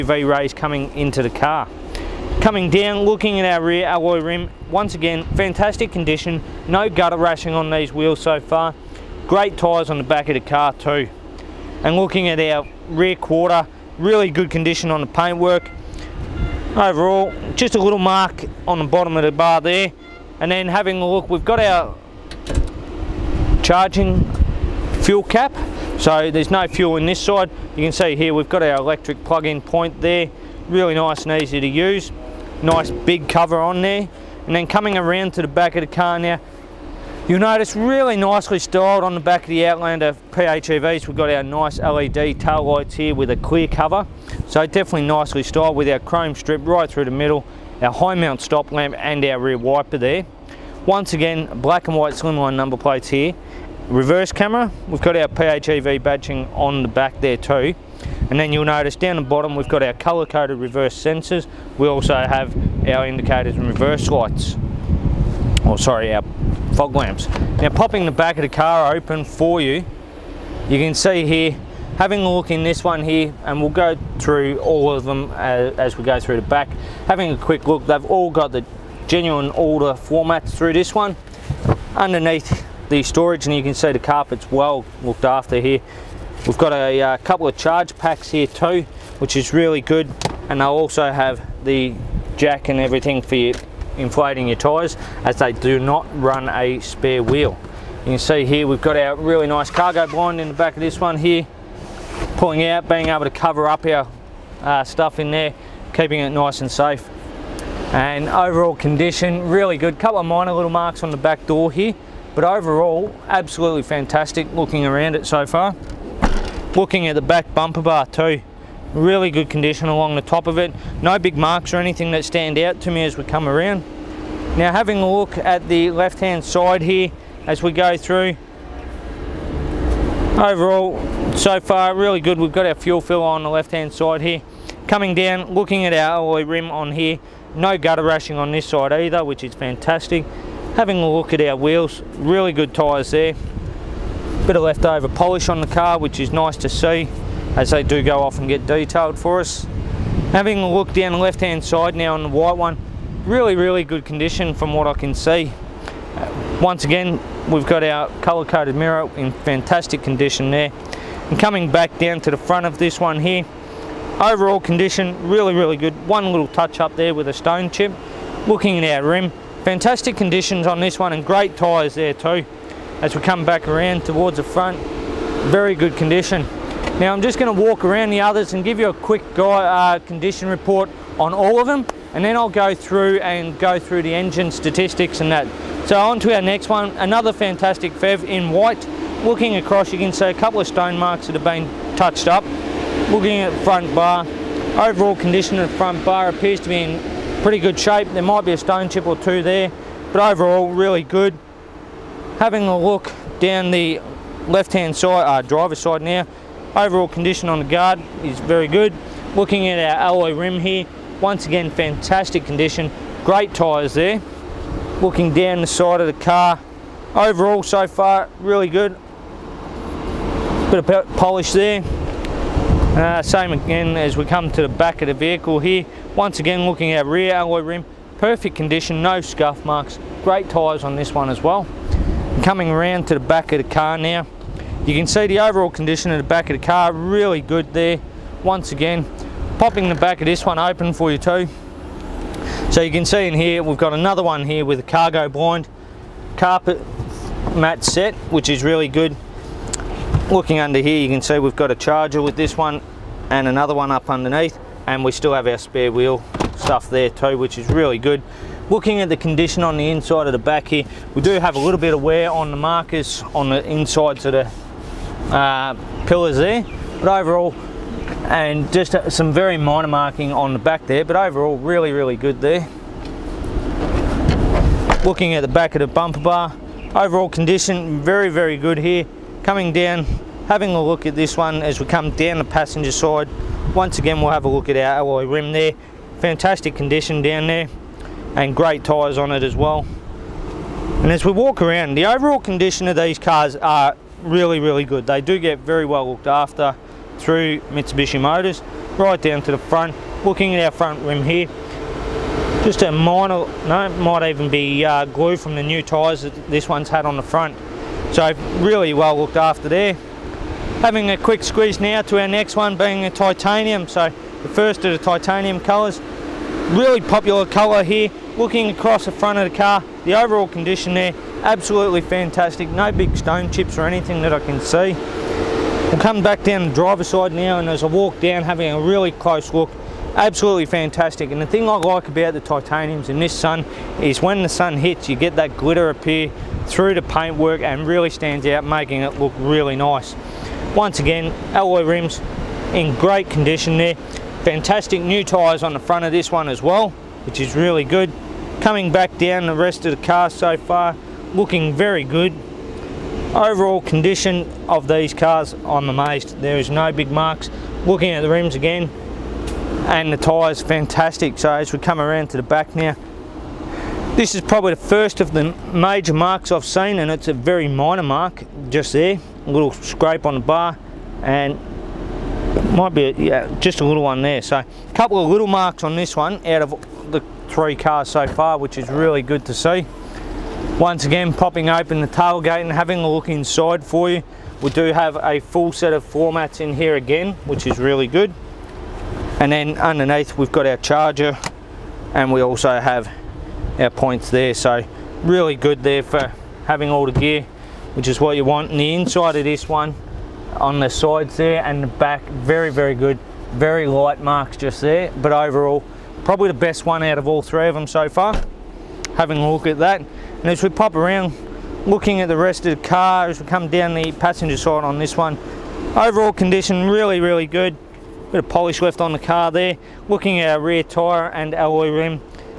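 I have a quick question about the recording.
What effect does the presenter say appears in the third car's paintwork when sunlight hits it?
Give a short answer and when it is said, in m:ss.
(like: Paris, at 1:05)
Glitter, at 5:35.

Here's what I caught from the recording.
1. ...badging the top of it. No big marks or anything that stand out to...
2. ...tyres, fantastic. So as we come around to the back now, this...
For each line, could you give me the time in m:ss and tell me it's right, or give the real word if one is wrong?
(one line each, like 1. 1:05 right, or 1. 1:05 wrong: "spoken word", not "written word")
1. 1:59 wrong: "along", not "badging"
2. 6:00 right.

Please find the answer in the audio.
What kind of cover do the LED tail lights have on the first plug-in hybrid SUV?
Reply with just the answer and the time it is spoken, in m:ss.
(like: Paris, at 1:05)
Clear cover, at 0:43.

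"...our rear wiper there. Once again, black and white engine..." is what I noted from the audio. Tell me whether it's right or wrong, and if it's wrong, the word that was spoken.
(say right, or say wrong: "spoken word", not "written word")
wrong: "slimline", not "engine".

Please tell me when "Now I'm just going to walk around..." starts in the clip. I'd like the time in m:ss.
2:57.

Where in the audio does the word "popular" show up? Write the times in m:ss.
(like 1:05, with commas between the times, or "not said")
5:17.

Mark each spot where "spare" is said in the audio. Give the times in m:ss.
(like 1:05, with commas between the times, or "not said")
1:36, 4:15.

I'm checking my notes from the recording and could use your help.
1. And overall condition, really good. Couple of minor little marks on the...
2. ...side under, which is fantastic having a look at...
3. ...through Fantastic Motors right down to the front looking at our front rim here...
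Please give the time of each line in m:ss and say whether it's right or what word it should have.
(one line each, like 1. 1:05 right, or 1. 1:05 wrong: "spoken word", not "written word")
1. 1:47 right
2. 2:18 wrong: "either", not "under"
3. 4:57 wrong: "Mitsubishi", not "Fantastic".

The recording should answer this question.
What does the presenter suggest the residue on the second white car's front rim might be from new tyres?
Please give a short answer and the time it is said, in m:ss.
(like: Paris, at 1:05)
Glue, at 5:05.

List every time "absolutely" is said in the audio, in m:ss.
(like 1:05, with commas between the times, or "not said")
1:53, 5:21, 5:30.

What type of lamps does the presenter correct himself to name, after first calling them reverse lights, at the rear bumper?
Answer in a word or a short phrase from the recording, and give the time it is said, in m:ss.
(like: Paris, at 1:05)
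Fog lamps, at 1:06.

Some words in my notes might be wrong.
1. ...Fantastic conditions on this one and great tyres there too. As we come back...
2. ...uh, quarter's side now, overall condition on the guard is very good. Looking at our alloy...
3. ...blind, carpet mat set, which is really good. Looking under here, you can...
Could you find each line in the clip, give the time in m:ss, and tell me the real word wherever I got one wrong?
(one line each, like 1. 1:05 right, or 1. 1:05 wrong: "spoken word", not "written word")
1. 2:49 right
2. 3:25 wrong: "driver", not "quarter"
3. 4:05 right.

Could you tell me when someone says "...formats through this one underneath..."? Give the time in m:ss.
1:19.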